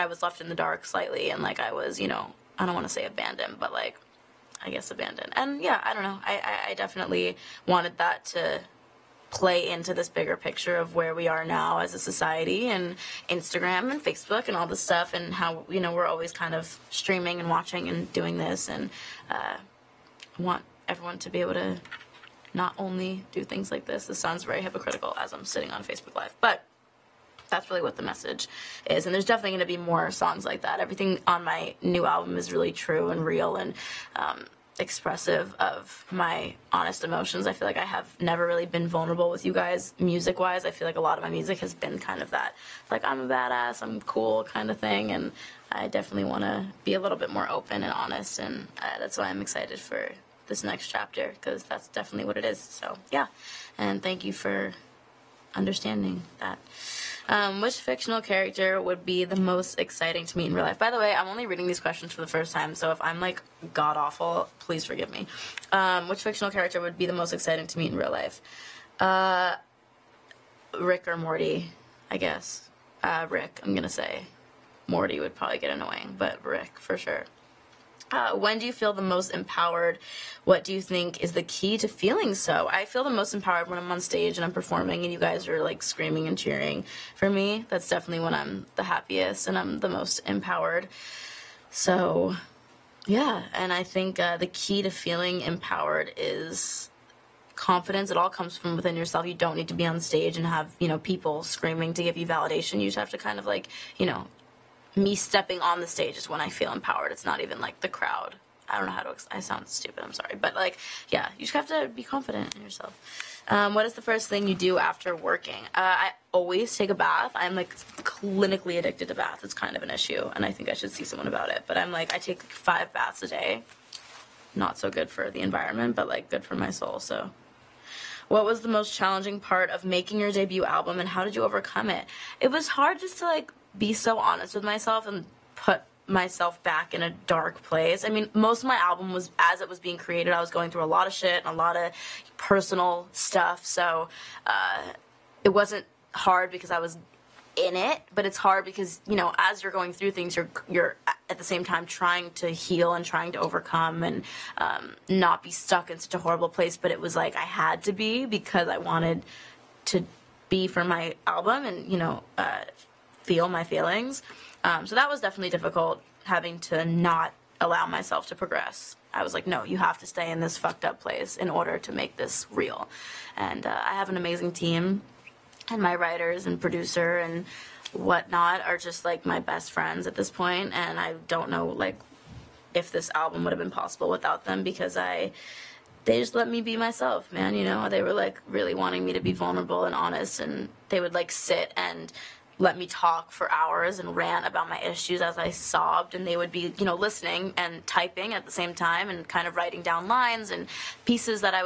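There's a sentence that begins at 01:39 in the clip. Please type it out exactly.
You don't need to be on stage and have, you know, people screaming to give you validation.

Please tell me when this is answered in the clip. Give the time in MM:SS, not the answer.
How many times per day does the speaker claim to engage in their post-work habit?
02:02.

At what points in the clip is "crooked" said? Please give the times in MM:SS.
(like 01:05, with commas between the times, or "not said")
not said.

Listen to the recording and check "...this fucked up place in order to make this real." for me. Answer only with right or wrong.
right.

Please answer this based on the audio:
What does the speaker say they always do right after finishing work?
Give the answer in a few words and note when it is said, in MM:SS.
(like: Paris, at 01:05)
Take a bath, at 01:56.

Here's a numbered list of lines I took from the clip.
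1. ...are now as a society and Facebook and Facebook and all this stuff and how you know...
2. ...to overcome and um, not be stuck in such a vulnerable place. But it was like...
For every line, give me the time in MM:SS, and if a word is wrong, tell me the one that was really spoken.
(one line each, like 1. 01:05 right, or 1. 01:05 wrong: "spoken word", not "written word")
1. 00:11 wrong: "Instagram", not "Facebook"
2. 02:33 wrong: "horrible", not "vulnerable".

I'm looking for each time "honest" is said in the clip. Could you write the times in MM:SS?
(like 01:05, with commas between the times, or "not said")
00:36, 00:47, 02:14, 03:09.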